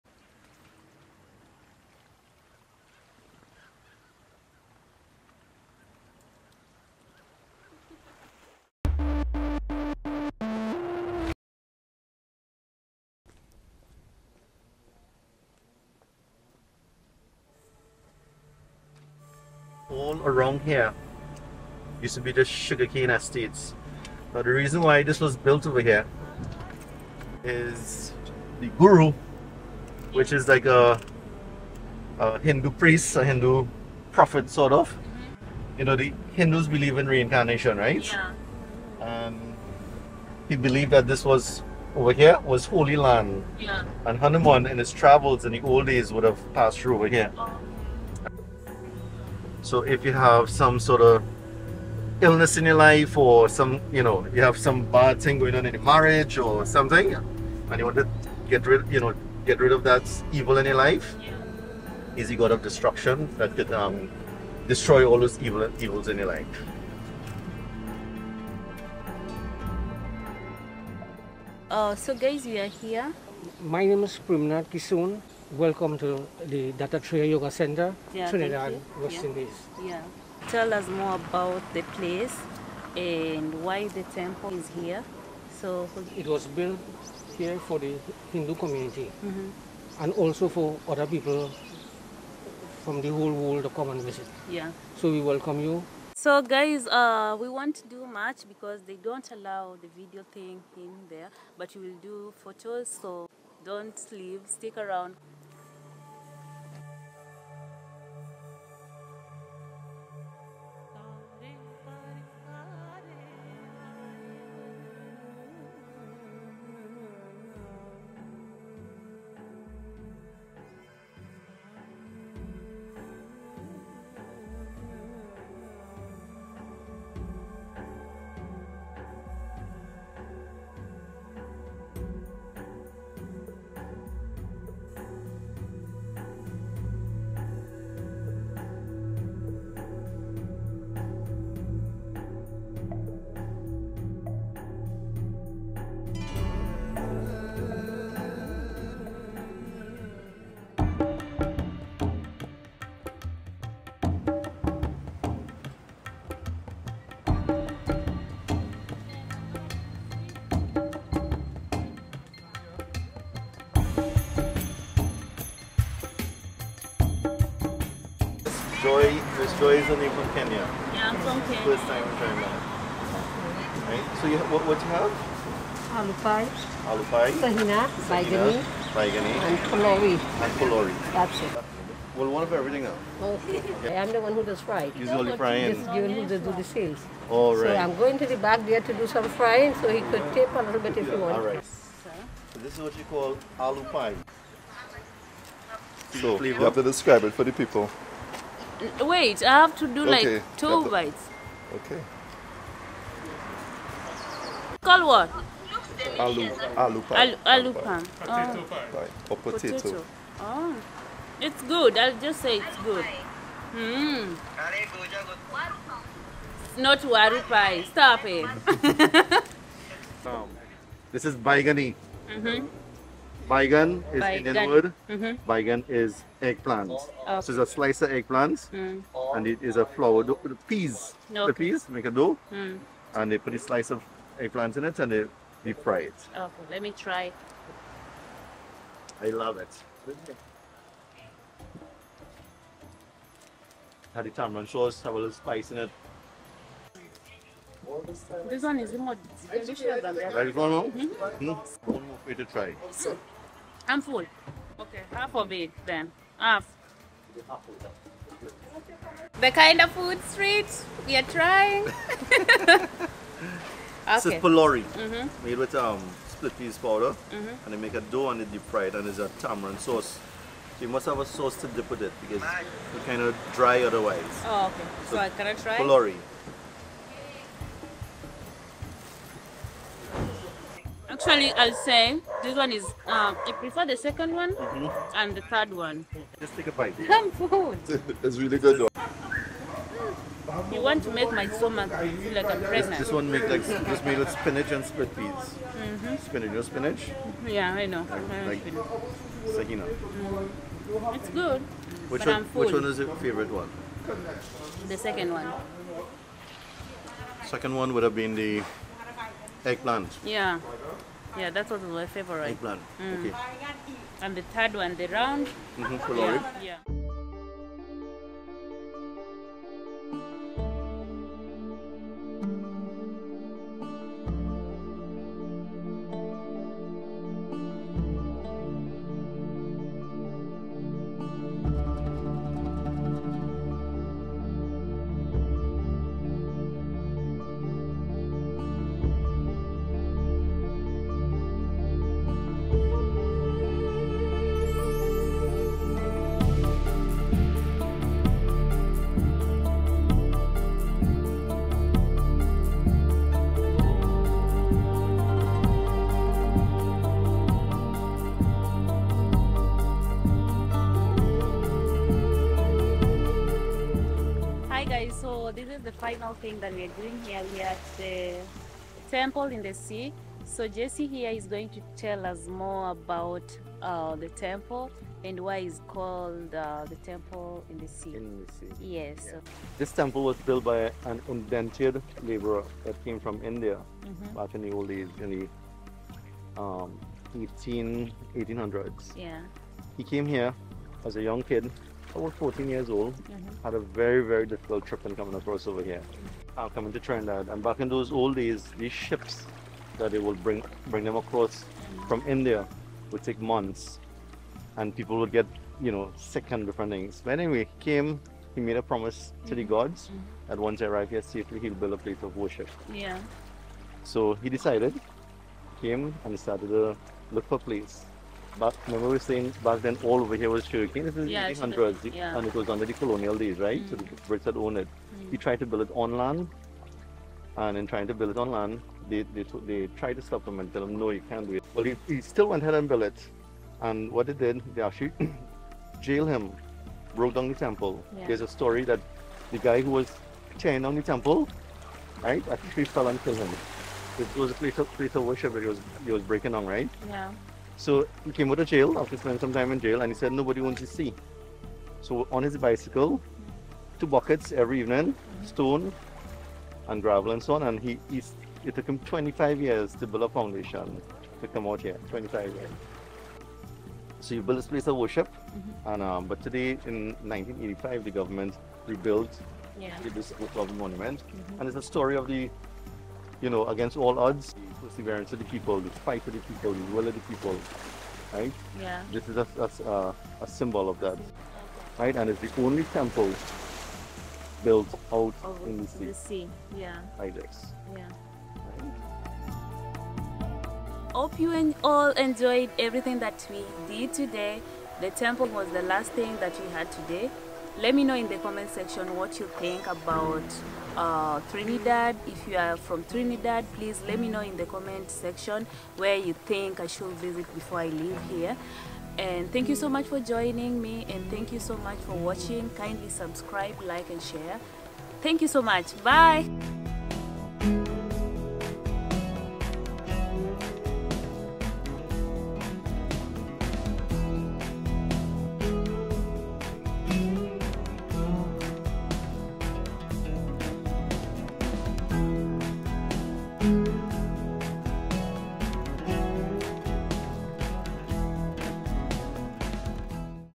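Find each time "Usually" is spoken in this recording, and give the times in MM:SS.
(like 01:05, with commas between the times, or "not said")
03:04.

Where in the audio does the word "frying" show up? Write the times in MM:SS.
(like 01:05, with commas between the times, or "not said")
03:05, 03:09.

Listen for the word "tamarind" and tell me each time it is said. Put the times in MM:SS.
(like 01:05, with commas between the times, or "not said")
04:04, 04:29.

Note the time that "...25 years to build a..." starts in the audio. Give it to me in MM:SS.
07:38.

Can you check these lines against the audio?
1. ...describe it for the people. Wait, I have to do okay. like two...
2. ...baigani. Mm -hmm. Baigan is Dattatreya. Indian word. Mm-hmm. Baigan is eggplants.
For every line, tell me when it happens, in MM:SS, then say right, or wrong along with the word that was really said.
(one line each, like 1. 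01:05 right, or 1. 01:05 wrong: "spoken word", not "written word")
1. 03:16 right
2. 03:41 wrong: "Baigan", not "Dattatreya".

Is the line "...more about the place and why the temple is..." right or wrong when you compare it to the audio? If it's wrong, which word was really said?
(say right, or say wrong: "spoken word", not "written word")
right.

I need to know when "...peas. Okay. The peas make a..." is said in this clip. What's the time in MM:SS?
03:50.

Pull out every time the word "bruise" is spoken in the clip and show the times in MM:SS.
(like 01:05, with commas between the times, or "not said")
not said.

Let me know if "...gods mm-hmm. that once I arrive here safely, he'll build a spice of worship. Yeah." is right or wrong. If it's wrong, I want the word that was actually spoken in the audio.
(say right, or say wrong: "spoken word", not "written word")
wrong: "place", not "spice".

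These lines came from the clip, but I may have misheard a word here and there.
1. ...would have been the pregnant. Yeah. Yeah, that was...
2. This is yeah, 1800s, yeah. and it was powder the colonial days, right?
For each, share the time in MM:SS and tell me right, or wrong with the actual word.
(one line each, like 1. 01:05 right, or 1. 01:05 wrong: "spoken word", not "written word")
1. 05:07 wrong: "eggplant", not "pregnant"
2. 07:01 wrong: "under", not "powder".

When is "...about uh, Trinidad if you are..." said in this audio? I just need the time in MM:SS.
08:19.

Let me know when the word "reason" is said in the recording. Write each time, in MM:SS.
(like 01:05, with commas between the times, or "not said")
00:24.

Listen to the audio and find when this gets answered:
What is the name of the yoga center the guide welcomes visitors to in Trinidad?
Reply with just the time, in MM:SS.
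01:16.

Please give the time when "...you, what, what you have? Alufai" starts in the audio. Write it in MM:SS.
02:54.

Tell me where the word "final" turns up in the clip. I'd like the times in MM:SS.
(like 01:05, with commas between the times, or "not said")
06:05.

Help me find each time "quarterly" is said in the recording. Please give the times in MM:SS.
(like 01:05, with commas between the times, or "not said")
not said.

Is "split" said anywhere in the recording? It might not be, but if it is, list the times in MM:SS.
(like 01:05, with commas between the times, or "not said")
04:26, 04:54.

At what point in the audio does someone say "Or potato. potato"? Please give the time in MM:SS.
03:29.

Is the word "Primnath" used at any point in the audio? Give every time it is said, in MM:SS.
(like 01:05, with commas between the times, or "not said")
01:14.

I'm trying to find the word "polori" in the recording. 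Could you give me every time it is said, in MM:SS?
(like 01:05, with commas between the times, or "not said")
04:24, 04:35.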